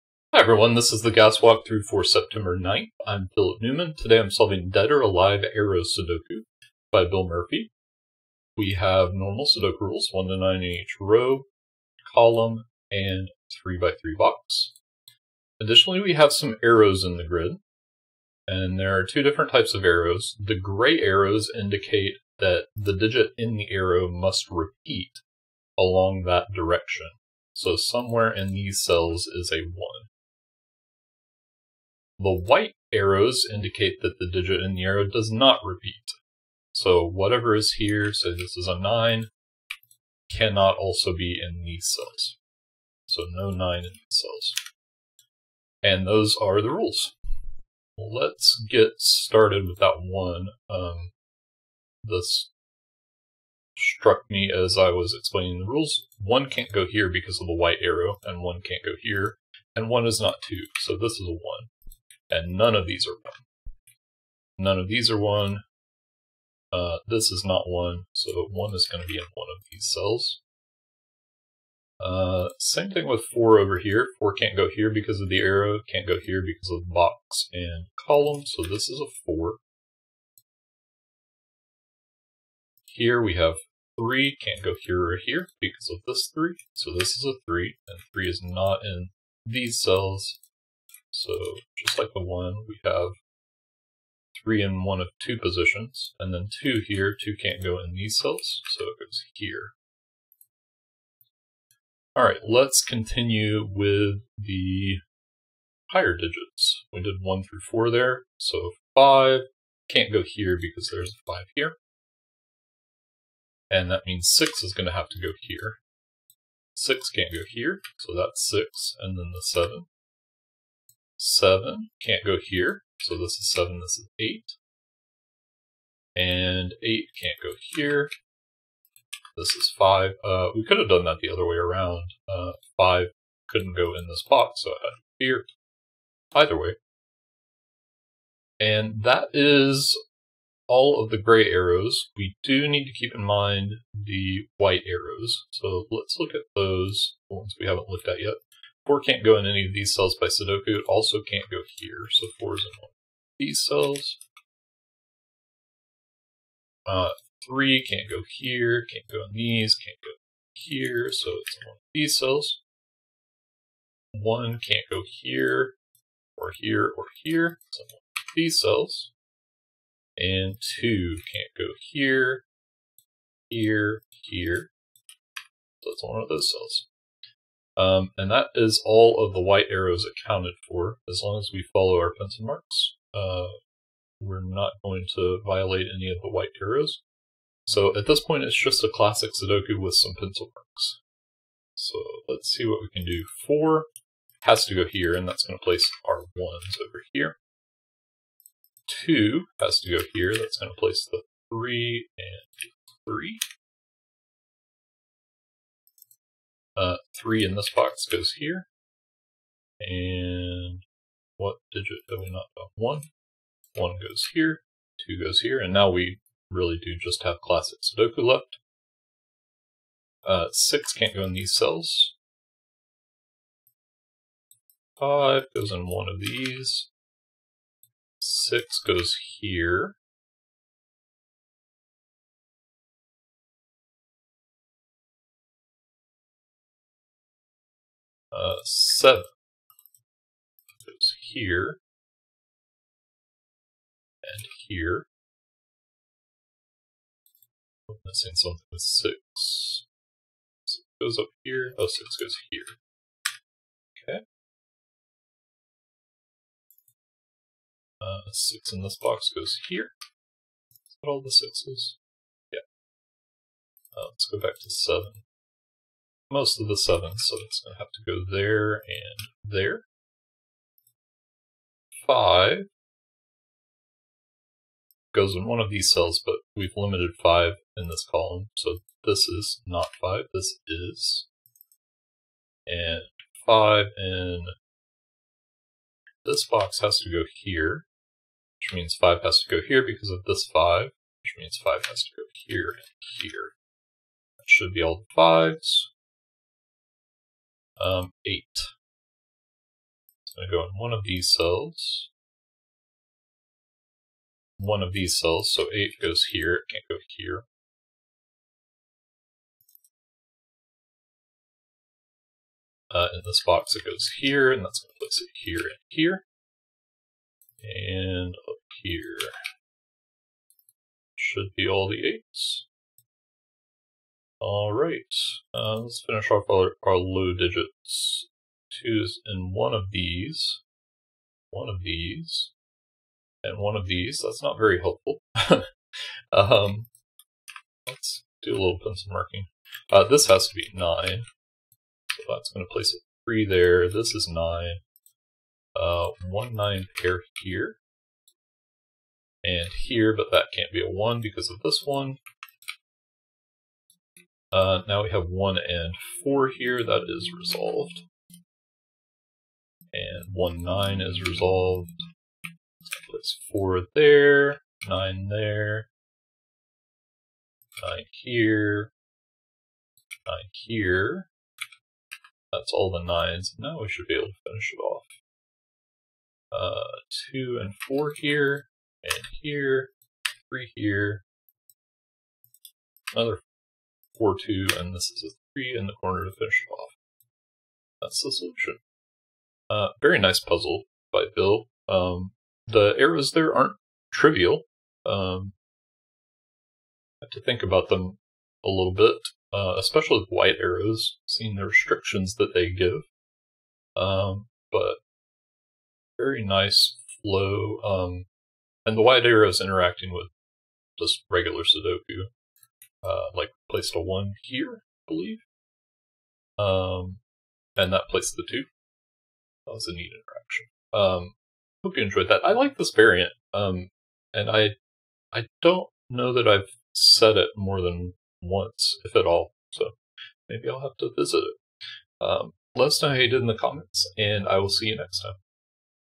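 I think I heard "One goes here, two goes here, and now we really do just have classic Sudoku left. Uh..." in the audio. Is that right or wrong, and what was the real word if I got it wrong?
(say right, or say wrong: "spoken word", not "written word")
right.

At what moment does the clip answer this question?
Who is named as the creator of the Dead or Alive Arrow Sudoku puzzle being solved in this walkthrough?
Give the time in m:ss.
0:07.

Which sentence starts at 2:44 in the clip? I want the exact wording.
1 can't go here, or here, or here, so one of these cells.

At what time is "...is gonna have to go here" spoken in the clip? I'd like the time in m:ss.
1:54.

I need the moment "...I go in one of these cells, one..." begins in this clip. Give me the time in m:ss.
5:00.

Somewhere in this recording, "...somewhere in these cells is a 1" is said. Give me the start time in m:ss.
0:27.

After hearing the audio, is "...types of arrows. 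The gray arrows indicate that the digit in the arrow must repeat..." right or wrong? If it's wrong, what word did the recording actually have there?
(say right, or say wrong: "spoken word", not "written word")
right.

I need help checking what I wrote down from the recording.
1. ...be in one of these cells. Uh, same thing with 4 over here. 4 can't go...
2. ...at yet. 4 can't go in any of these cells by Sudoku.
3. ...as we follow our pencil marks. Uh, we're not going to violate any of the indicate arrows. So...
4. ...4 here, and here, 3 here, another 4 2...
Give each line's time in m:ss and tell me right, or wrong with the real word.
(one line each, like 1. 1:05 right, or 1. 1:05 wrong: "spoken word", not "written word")
1. 1:09 right
2. 2:28 right
3. 3:01 wrong: "white", not "indicate"
4. 6:17 right.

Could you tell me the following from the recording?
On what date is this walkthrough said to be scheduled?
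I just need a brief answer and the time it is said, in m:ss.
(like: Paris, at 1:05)
September 9th, at 0:02.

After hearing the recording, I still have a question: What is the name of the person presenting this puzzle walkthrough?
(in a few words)
Philip Newman.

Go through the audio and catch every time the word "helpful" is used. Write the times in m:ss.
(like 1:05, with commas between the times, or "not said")
5:34.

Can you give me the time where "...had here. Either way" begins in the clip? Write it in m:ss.
2:14.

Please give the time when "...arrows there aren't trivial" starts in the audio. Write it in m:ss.
6:32.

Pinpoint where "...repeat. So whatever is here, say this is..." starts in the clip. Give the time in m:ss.
0:35.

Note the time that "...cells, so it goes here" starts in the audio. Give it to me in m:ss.
1:38.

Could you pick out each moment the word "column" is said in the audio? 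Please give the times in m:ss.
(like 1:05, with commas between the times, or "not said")
0:12, 1:18, 4:38.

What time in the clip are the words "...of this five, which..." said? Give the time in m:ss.
4:50.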